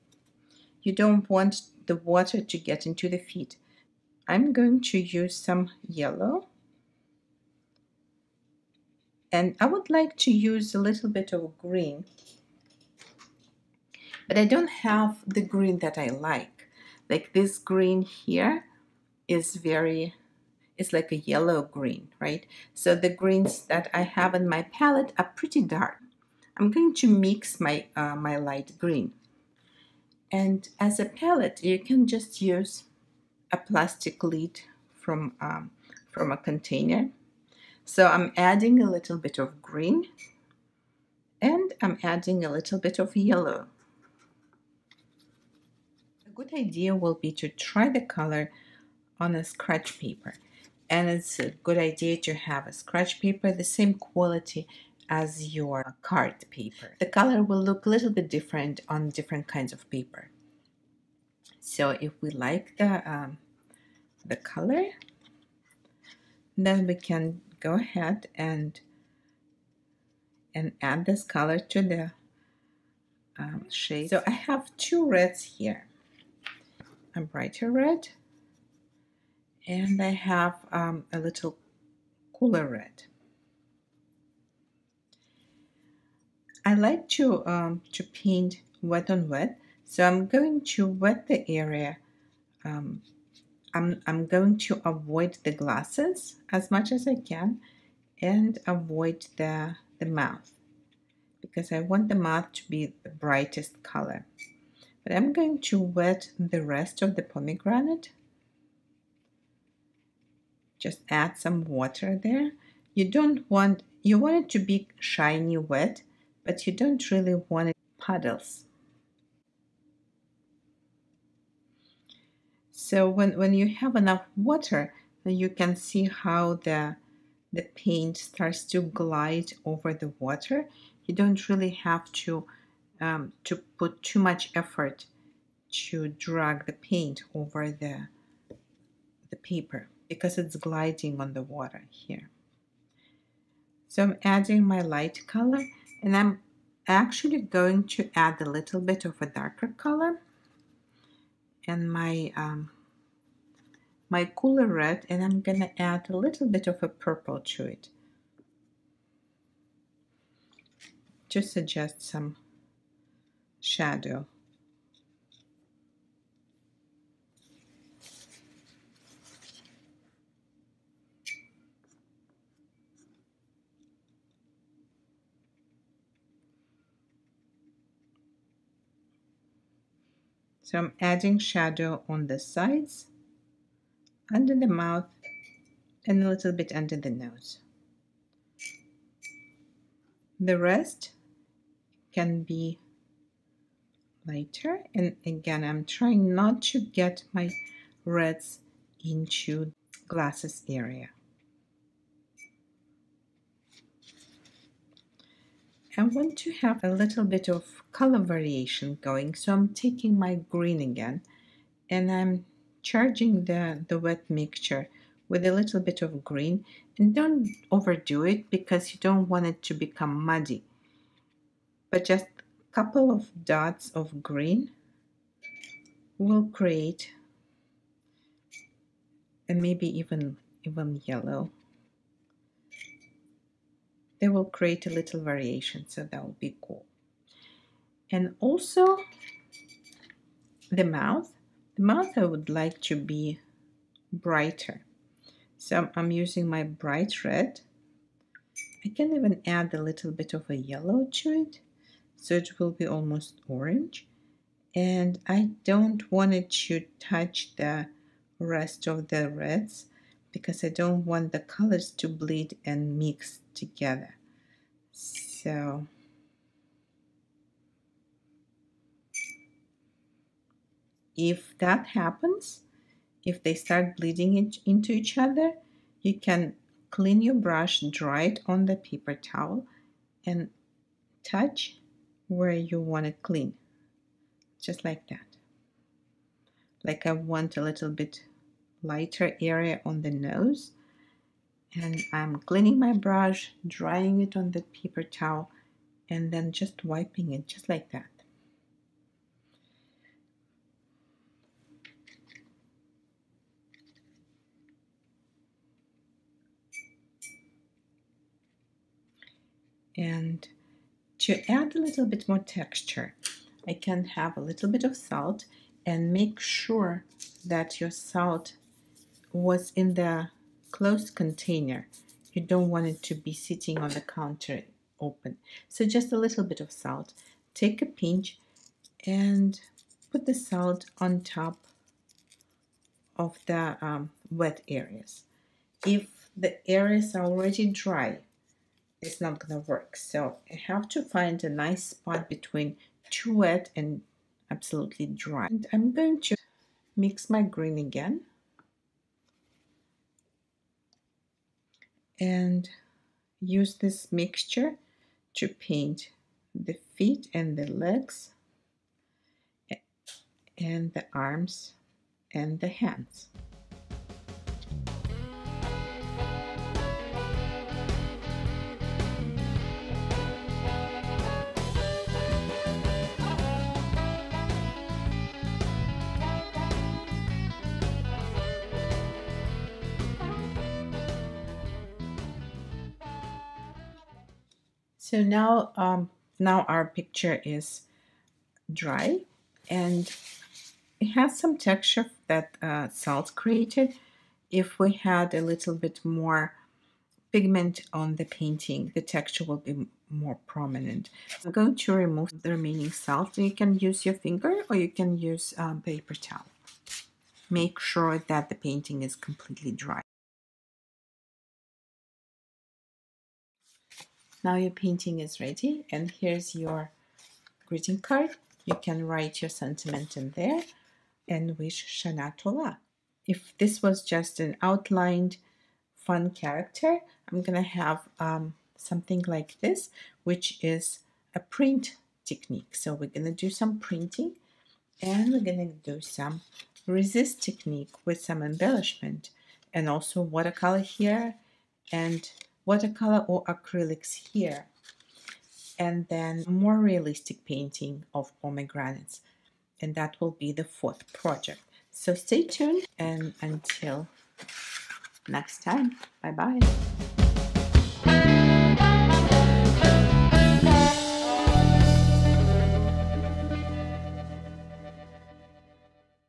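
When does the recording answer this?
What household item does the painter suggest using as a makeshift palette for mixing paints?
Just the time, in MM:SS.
00:33.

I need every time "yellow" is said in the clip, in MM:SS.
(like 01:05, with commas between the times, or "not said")
00:05, 00:21, 00:43, 03:51, 04:10.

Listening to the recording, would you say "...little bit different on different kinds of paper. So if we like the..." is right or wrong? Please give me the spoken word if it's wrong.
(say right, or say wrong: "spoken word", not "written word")
right.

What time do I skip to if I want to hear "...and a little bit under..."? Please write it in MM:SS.
03:06.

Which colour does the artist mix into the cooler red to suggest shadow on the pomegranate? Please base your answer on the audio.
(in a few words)
purple.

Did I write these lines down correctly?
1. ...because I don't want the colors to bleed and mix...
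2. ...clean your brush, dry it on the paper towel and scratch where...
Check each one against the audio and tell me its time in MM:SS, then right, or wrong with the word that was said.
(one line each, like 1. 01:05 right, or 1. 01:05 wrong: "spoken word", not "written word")
1. 04:20 right
2. 04:36 wrong: "touch", not "scratch".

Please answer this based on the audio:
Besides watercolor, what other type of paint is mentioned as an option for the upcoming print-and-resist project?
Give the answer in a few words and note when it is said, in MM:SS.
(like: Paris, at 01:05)
acrylics, at 07:23.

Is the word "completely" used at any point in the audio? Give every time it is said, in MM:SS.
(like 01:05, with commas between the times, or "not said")
06:49.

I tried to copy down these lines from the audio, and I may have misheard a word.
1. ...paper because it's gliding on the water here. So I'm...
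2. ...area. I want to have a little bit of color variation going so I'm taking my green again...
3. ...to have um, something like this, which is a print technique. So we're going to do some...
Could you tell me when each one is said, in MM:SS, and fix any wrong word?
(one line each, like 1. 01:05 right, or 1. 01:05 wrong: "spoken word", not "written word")
1. 02:19 right
2. 03:20 right
3. 07:07 right.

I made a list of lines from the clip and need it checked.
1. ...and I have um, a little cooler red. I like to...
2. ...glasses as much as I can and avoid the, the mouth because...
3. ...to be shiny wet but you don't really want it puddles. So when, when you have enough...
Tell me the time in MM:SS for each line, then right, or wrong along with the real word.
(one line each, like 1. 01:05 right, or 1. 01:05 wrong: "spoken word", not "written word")
1. 01:19 right
2. 01:35 right
3. 01:54 right.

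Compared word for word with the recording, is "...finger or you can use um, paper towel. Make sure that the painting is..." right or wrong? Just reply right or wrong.
right.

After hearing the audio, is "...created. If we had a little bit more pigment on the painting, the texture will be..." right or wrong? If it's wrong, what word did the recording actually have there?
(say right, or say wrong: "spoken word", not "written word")
right.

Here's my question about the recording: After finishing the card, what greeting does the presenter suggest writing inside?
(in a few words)
Shana Tova.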